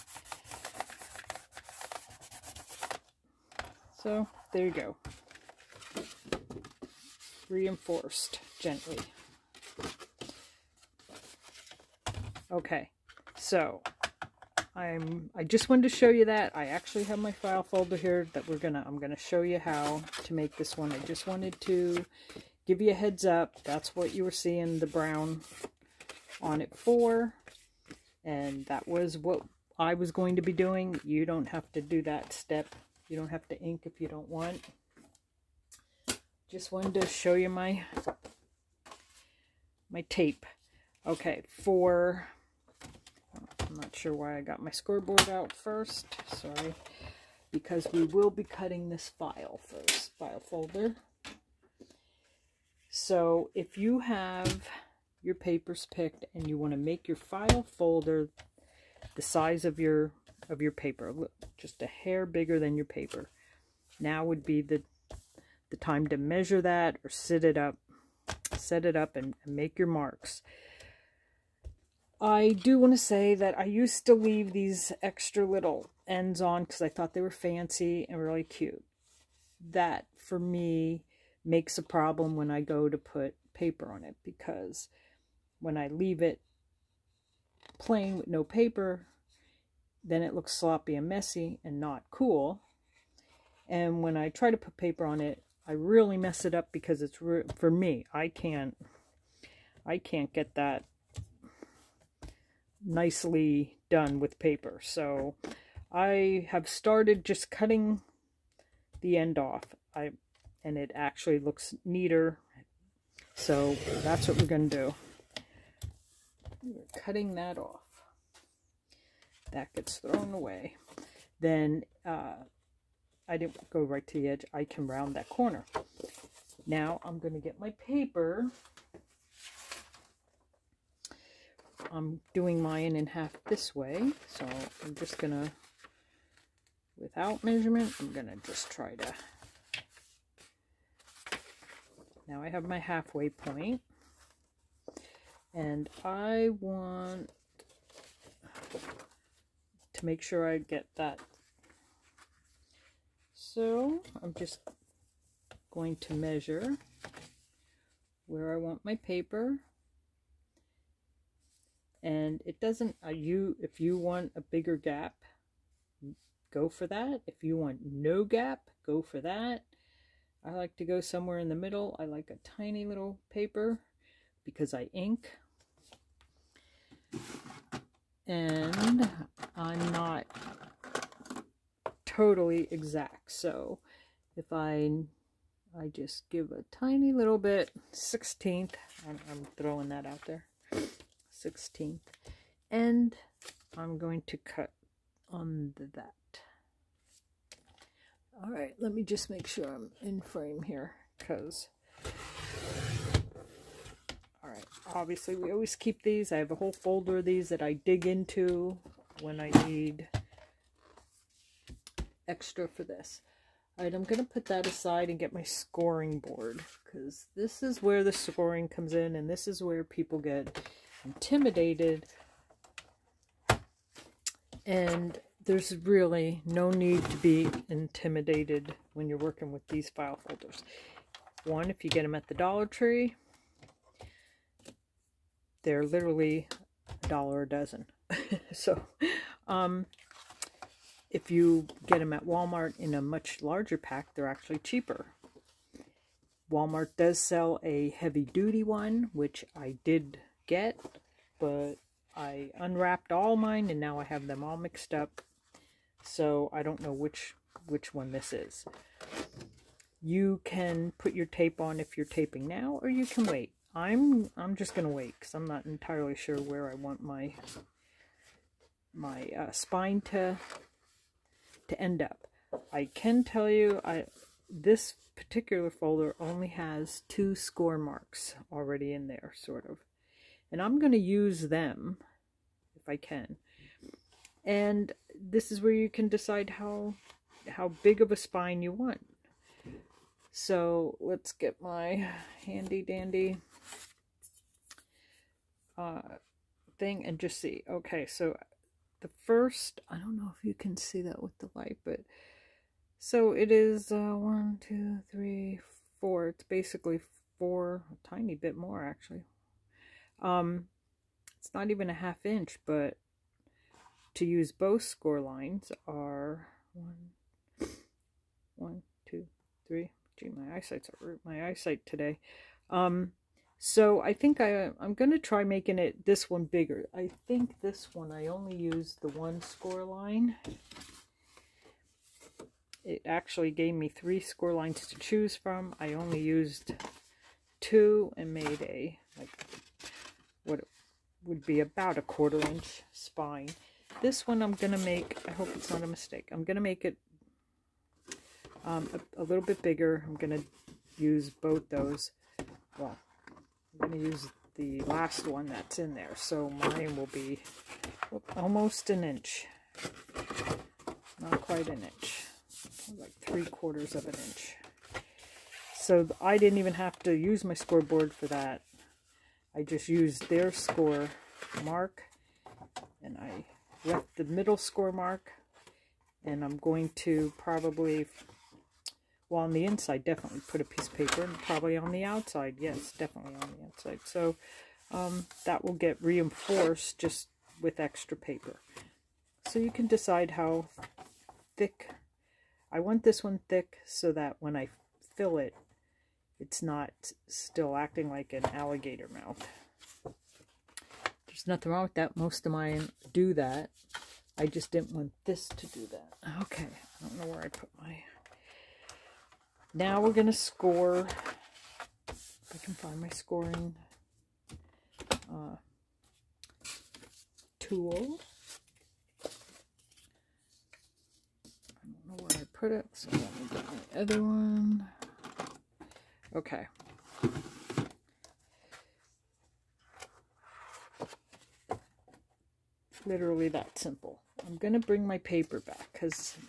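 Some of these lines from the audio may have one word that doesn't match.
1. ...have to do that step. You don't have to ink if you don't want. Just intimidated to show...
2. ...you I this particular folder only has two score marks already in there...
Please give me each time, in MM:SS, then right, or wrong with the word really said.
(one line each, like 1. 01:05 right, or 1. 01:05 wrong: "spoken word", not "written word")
1. 00:31 wrong: "wanted", not "intimidated"
2. 04:33 right.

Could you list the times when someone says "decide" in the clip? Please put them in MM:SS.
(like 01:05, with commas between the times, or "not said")
04:46, 06:29.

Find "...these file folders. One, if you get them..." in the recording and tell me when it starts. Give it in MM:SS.
03:49.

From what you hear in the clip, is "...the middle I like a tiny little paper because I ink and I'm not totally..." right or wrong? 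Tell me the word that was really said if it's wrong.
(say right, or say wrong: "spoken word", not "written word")
right.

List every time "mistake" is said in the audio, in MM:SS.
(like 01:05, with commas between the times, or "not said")
05:45.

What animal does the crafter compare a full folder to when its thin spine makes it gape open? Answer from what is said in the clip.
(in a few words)
alligator.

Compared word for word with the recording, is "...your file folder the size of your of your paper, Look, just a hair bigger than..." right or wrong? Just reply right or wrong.
right.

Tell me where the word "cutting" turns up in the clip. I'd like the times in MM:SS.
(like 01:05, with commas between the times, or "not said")
00:48, 01:47, 01:57.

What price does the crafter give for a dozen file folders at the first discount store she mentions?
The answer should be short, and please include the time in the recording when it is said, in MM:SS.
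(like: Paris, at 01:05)
a dollar, at 03:57.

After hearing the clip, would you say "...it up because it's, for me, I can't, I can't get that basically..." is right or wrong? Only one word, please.
wrong.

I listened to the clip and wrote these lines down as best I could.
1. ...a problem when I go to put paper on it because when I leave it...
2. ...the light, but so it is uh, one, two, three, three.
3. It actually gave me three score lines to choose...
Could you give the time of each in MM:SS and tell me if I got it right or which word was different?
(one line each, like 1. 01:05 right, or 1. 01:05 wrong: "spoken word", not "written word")
1. 01:21 right
2. 05:01 wrong: "four", not "three"
3. 05:32 right.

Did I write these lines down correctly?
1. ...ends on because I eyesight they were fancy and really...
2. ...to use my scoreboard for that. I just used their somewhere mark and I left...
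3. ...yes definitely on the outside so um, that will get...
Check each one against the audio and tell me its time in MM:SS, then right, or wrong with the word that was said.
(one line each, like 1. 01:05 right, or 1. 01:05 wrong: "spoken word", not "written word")
1. 01:16 wrong: "thought", not "eyesight"
2. 06:06 wrong: "score", not "somewhere"
3. 06:22 right.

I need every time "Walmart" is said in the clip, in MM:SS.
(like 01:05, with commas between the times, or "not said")
04:02, 04:06.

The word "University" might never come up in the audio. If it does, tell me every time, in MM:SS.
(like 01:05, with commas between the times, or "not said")
not said.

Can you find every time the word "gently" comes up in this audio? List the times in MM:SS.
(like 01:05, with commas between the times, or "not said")
00:08.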